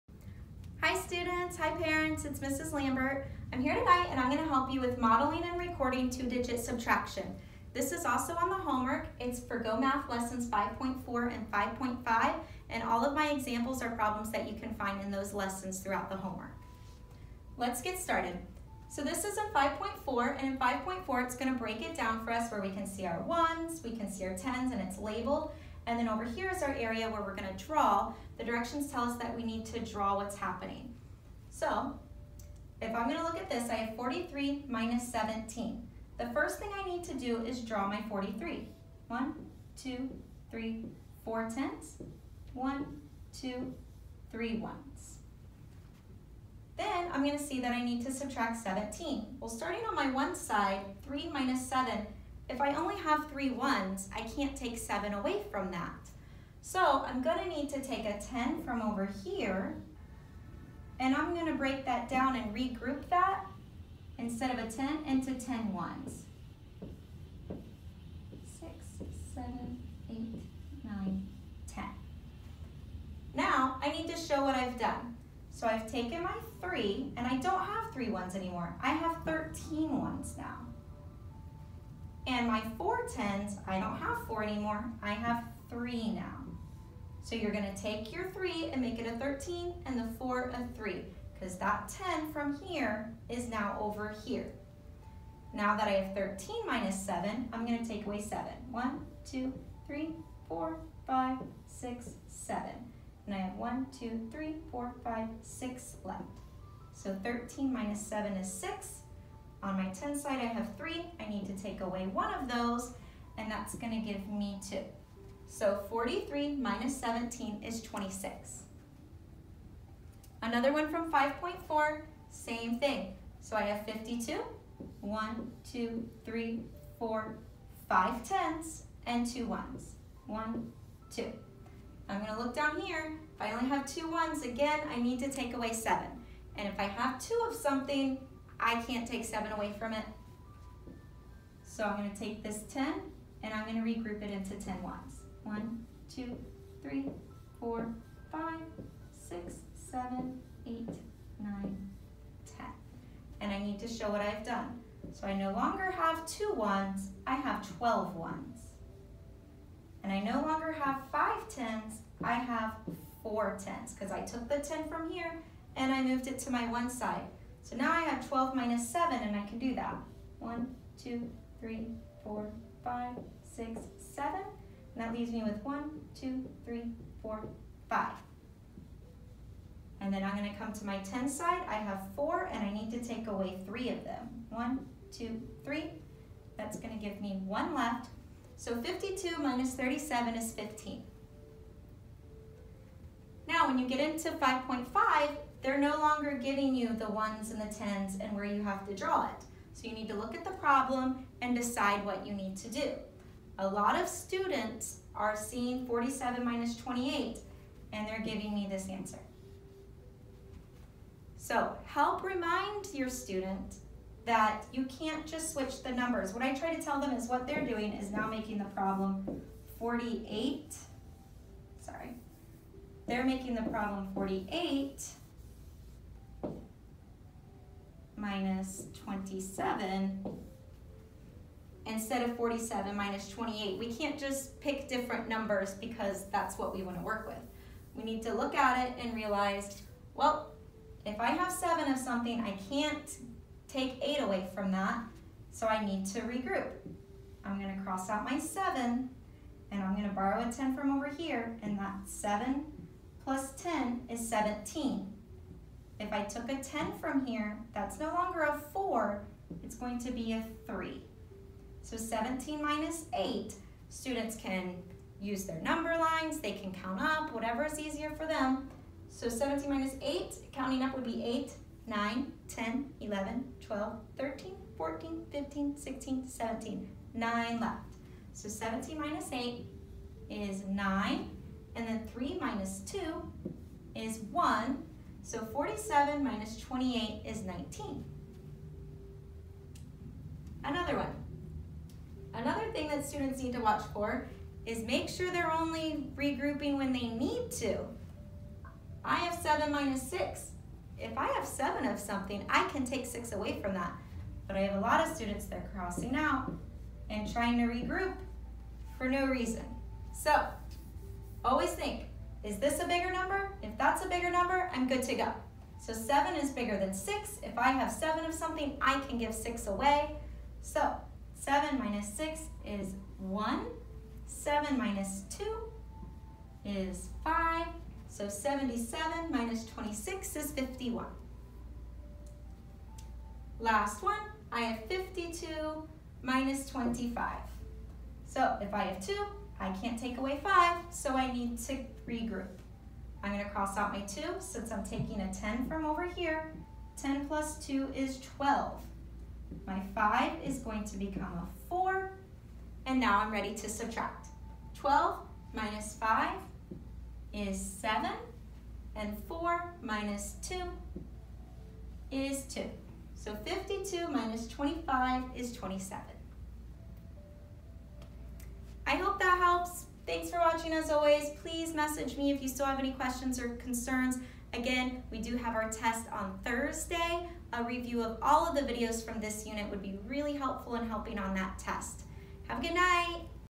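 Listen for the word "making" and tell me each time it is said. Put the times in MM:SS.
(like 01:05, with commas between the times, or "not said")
03:38, 03:43.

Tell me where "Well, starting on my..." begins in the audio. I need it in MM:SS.
00:49.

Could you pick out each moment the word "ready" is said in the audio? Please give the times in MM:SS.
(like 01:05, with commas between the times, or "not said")
05:53.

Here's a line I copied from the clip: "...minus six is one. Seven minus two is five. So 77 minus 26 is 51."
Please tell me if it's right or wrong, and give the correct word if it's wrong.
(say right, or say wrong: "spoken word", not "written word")
right.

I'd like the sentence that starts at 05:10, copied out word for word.
So Always think, is this a bigger number?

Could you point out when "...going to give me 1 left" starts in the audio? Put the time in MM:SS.
03:06.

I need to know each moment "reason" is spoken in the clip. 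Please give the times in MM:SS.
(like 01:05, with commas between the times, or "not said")
05:09.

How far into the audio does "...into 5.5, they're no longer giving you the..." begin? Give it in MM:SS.
03:14.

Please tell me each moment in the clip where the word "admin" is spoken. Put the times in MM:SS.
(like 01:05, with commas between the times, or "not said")
not said.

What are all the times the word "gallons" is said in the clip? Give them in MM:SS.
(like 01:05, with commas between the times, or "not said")
not said.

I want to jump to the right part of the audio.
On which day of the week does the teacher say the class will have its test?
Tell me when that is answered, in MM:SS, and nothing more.
06:16.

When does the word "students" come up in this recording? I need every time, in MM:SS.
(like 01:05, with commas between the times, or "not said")
00:00, 03:24, 03:33, 04:23, 04:53, 05:05.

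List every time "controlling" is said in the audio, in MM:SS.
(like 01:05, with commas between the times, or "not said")
not said.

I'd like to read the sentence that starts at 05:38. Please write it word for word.
So if I have two, I can't take away five, so I need to regroup.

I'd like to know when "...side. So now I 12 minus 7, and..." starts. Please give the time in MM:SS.
02:46.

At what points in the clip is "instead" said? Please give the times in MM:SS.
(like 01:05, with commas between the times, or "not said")
01:04, 03:51.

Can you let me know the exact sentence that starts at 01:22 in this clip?
And my four tens, I don't have four anymore, I have three now.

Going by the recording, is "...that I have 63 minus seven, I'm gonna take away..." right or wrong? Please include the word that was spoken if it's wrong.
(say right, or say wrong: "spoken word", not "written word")
wrong: "13", not "63".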